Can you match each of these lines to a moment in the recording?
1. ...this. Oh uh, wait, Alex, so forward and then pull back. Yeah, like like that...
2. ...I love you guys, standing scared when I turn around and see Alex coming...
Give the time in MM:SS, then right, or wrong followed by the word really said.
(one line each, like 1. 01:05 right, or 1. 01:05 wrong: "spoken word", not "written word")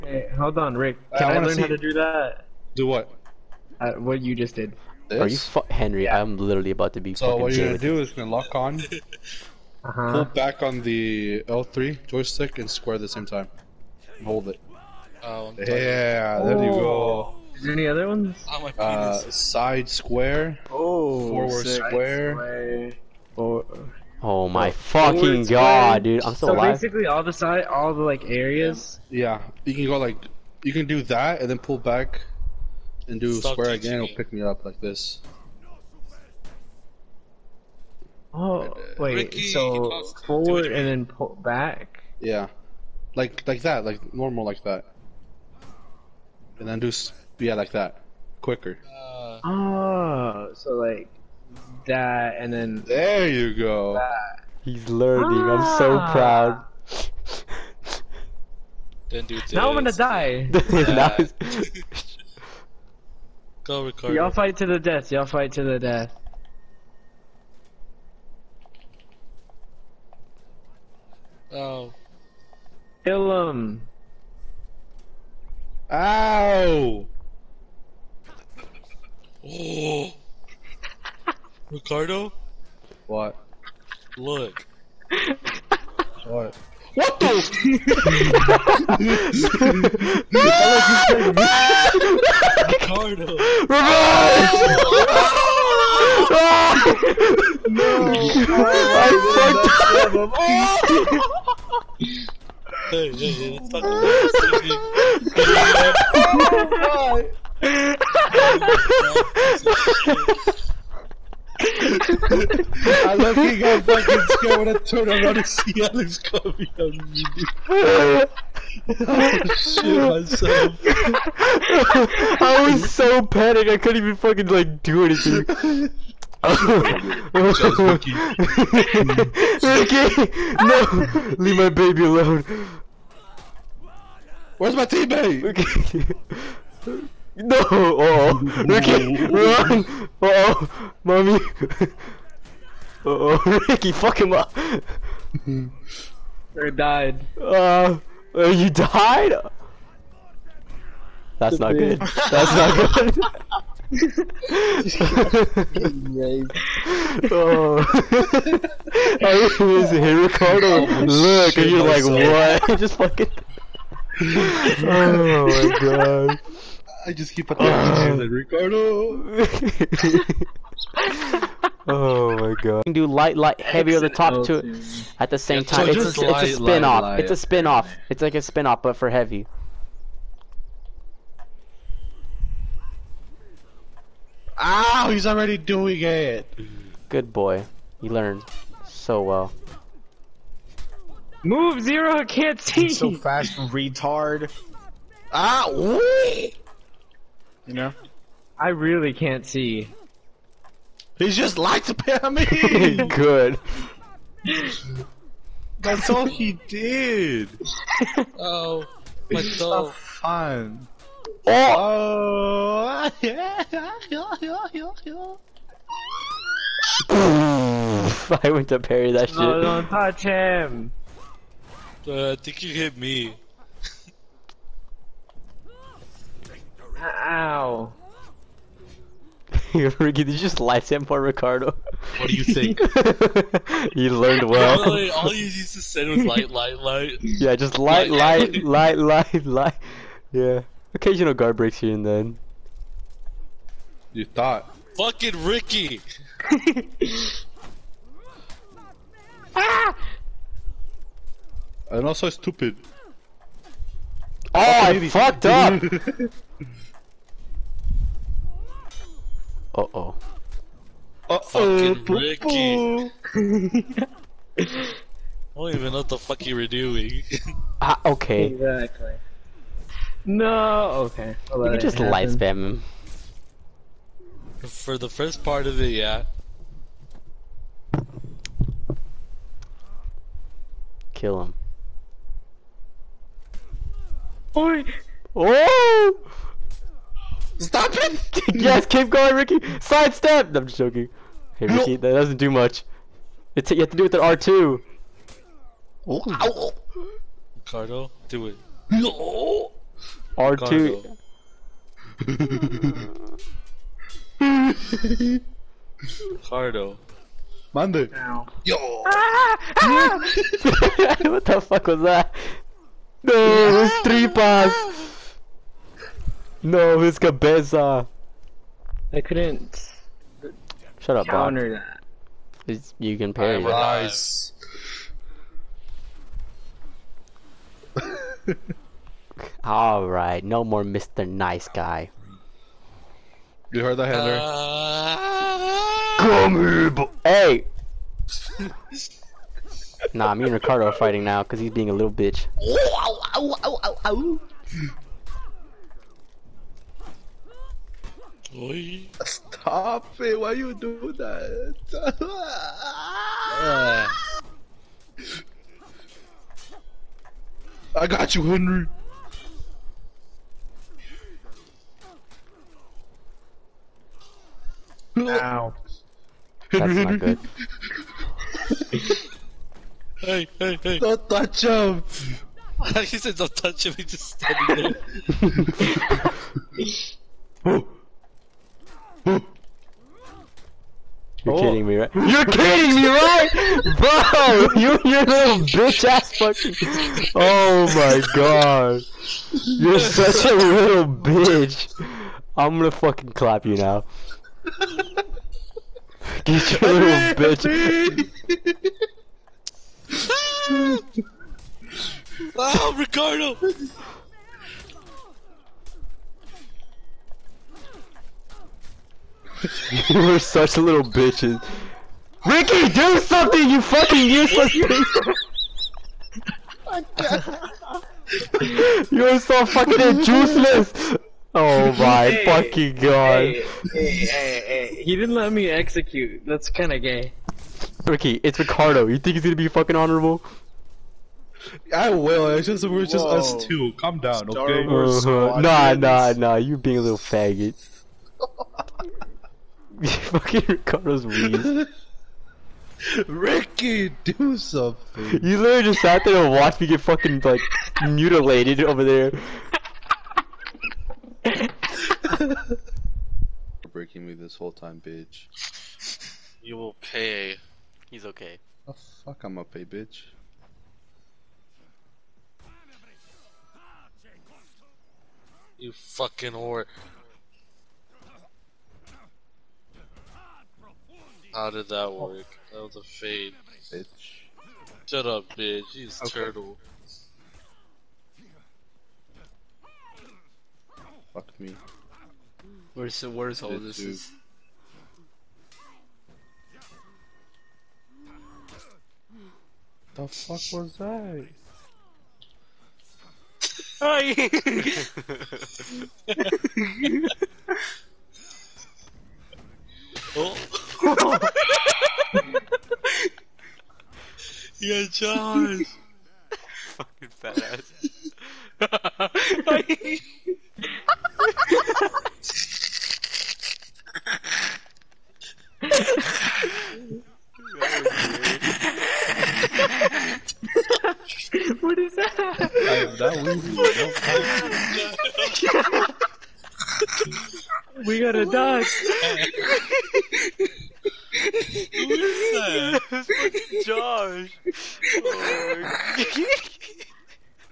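1. 00:34 wrong: "Ricky", not "Alex"
2. 01:51 wrong: "fucking", not "standing".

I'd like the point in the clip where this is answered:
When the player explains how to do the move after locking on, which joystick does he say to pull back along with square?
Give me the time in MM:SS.
00:11.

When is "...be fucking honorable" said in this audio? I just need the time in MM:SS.
07:09.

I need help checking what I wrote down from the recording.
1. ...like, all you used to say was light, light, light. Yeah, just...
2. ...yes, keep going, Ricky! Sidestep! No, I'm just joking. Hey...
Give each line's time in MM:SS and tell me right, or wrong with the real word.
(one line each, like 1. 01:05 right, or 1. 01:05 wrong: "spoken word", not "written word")
1. 03:54 right
2. 04:48 right.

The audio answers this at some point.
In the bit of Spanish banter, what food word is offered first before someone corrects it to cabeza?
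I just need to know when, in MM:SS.
05:14.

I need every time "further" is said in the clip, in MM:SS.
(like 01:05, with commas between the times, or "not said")
not said.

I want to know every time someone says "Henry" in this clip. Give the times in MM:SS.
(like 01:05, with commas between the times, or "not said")
00:05, 05:34, 05:58.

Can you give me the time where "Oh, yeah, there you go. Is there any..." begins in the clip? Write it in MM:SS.
00:15.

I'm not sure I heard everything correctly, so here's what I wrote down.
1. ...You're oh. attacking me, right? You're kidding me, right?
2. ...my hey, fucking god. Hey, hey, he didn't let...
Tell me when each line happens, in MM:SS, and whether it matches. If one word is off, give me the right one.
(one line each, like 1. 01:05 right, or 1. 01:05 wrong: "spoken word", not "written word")
1. 06:21 wrong: "kidding", not "attacking"
2. 07:01 right.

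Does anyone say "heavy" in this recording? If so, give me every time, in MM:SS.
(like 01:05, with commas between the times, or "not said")
02:53, 02:59.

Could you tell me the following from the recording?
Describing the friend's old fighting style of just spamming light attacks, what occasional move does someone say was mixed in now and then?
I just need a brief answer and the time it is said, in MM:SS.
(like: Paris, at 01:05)
Guard breaks, at 04:01.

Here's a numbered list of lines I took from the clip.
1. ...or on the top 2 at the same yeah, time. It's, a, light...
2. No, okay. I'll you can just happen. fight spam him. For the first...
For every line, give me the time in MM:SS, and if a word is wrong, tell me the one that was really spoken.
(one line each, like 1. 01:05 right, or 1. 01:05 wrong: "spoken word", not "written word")
1. 02:53 right
2. 04:30 wrong: "light", not "fight".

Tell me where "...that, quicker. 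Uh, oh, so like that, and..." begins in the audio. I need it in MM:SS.
00:47.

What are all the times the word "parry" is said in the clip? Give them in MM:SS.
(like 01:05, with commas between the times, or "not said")
03:38, 05:23.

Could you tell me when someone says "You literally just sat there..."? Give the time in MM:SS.
07:25.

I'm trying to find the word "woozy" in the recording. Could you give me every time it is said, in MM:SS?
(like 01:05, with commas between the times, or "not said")
08:47.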